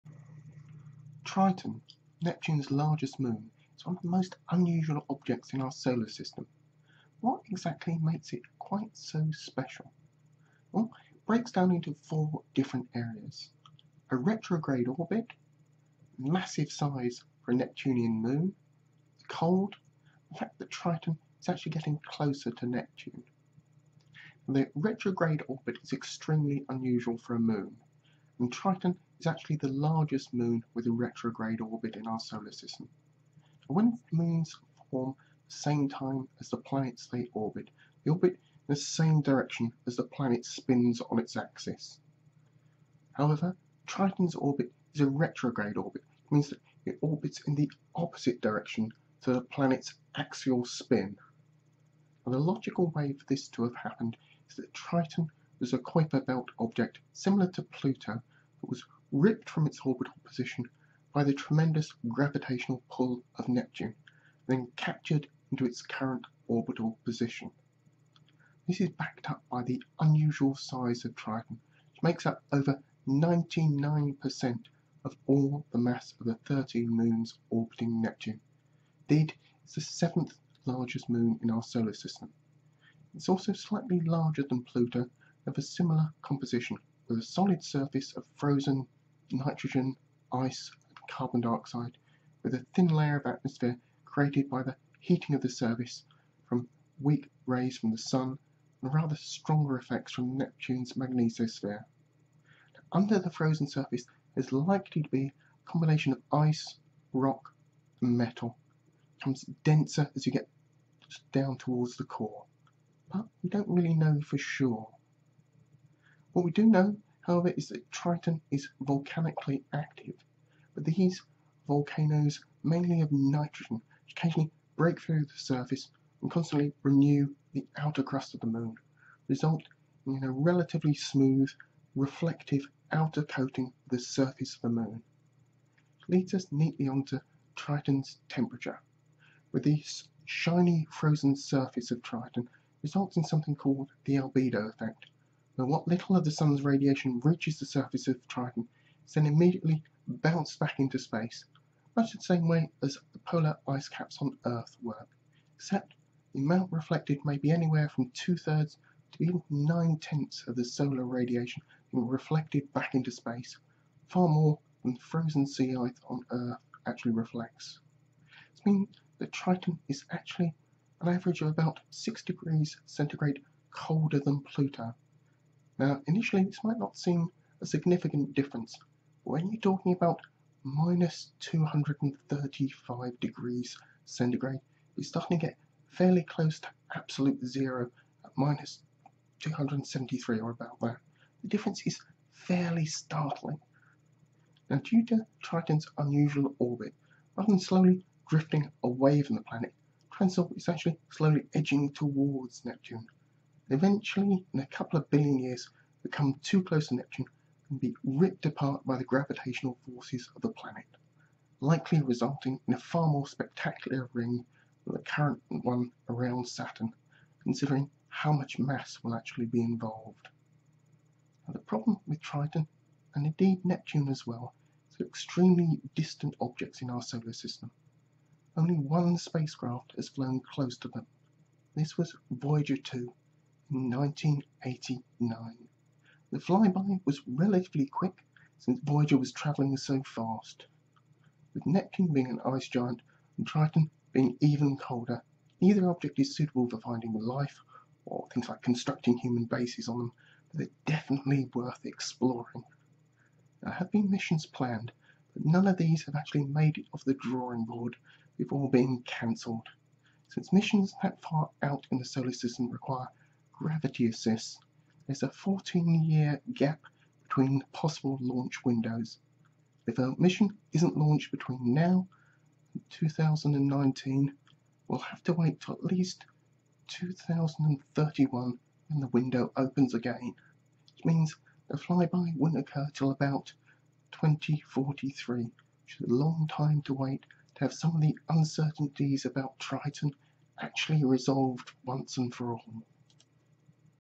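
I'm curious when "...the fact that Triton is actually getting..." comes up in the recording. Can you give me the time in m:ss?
0:20.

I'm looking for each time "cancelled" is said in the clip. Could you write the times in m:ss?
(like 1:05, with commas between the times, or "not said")
4:19.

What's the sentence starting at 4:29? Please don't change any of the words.
If a mission isn't launched between now and 2019, we'll have to wait for at least 2031 when the window opens again.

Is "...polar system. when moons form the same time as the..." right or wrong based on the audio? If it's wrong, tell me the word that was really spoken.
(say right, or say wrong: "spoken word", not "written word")
wrong: "solar", not "polar".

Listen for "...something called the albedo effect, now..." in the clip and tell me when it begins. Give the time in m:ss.
2:23.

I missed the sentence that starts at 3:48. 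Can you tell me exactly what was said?
Only one spacecraft has flown close to them.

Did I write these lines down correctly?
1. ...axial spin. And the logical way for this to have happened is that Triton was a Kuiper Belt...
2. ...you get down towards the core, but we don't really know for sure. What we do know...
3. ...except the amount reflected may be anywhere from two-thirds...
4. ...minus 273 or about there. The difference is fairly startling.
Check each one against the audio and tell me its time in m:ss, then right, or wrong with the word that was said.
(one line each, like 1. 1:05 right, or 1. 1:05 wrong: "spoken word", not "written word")
1. 0:50 right
2. 1:50 right
3. 2:35 right
4. 3:08 right.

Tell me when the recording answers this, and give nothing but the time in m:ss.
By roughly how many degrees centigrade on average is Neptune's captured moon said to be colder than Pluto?
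2:51.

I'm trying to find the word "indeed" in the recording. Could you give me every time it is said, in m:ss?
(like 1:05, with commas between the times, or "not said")
1:19, 3:43.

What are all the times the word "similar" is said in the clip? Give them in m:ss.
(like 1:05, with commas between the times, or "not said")
0:57, 1:25.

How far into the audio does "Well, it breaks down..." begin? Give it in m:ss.
0:10.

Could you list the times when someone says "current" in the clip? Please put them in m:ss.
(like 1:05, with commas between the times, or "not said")
1:05, 3:35.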